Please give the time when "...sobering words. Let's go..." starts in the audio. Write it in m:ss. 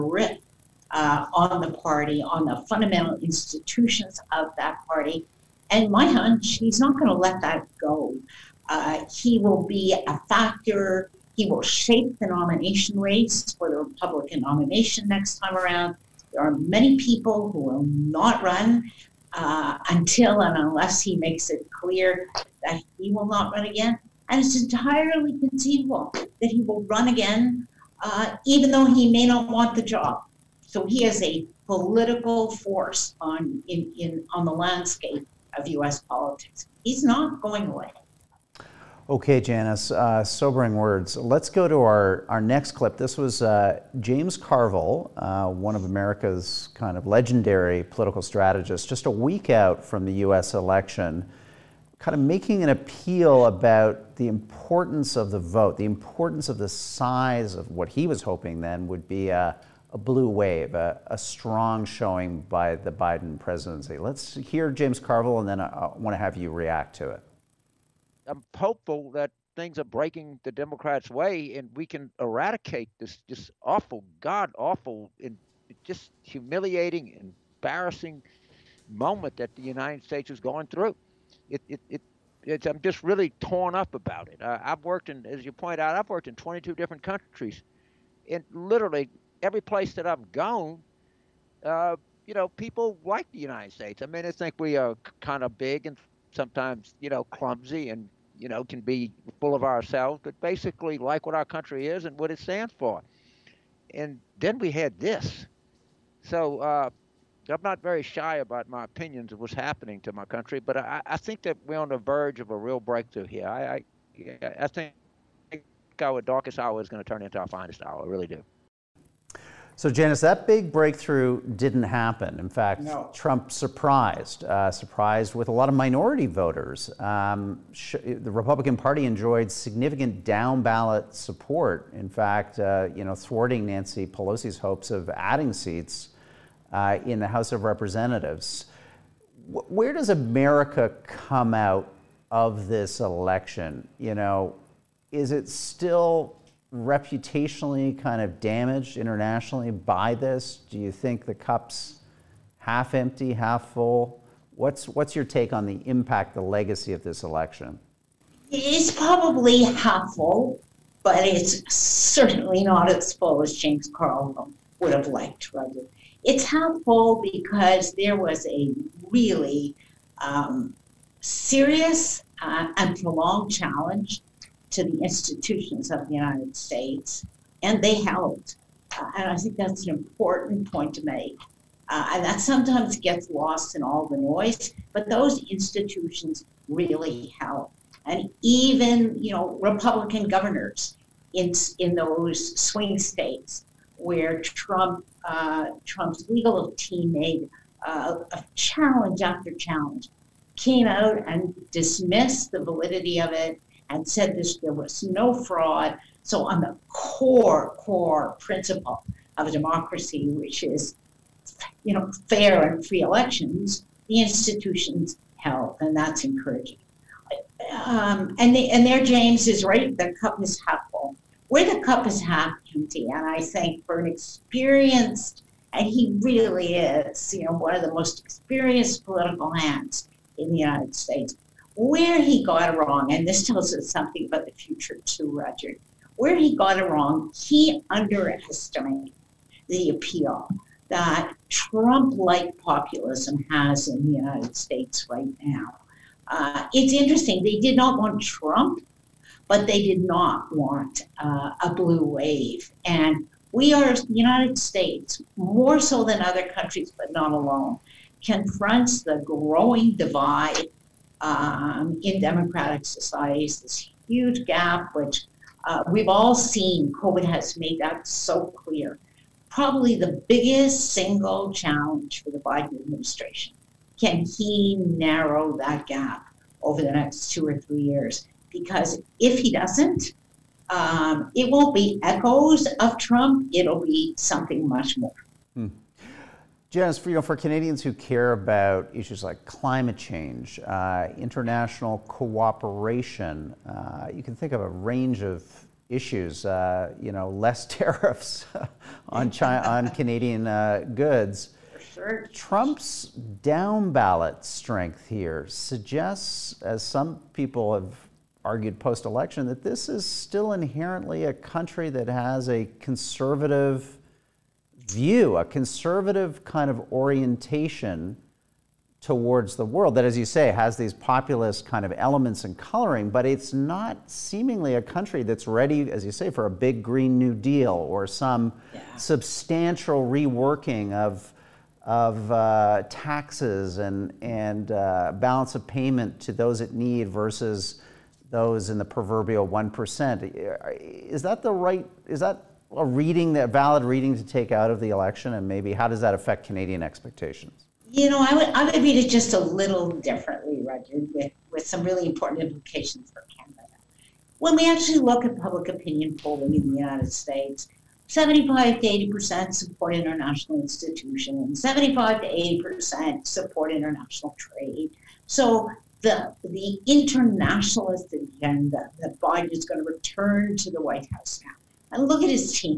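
0:40.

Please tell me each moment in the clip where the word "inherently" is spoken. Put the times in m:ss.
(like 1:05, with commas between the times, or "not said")
5:10.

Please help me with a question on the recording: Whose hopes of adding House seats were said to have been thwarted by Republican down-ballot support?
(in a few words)
Nancy Pelosi.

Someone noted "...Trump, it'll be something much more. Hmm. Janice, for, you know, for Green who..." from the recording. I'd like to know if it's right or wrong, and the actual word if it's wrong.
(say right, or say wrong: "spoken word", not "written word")
wrong: "Canadians", not "Green".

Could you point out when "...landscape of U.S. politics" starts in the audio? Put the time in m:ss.
0:34.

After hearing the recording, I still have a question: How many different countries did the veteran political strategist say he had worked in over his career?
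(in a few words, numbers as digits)
22.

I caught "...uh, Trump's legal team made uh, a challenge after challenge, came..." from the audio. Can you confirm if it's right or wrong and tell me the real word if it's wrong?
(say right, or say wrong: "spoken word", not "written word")
right.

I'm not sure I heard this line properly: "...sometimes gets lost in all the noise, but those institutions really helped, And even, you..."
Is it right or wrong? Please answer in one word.
right.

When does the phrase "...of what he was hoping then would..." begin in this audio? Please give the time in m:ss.
0:57.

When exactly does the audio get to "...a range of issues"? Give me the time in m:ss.
4:54.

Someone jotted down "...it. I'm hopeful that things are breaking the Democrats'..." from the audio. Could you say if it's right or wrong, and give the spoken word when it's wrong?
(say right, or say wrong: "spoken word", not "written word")
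right.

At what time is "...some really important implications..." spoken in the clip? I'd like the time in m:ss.
5:51.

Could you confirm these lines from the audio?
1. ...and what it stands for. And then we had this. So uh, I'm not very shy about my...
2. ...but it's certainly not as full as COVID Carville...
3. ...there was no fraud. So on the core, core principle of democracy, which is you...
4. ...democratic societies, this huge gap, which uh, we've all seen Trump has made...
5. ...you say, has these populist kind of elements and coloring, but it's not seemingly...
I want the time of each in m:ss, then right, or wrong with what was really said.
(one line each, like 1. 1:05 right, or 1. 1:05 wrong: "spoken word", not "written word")
1. 1:42 right
2. 2:41 wrong: "James", not "COVID"
3. 3:24 right
4. 4:22 wrong: "COVID", not "Trump"
5. 5:20 right.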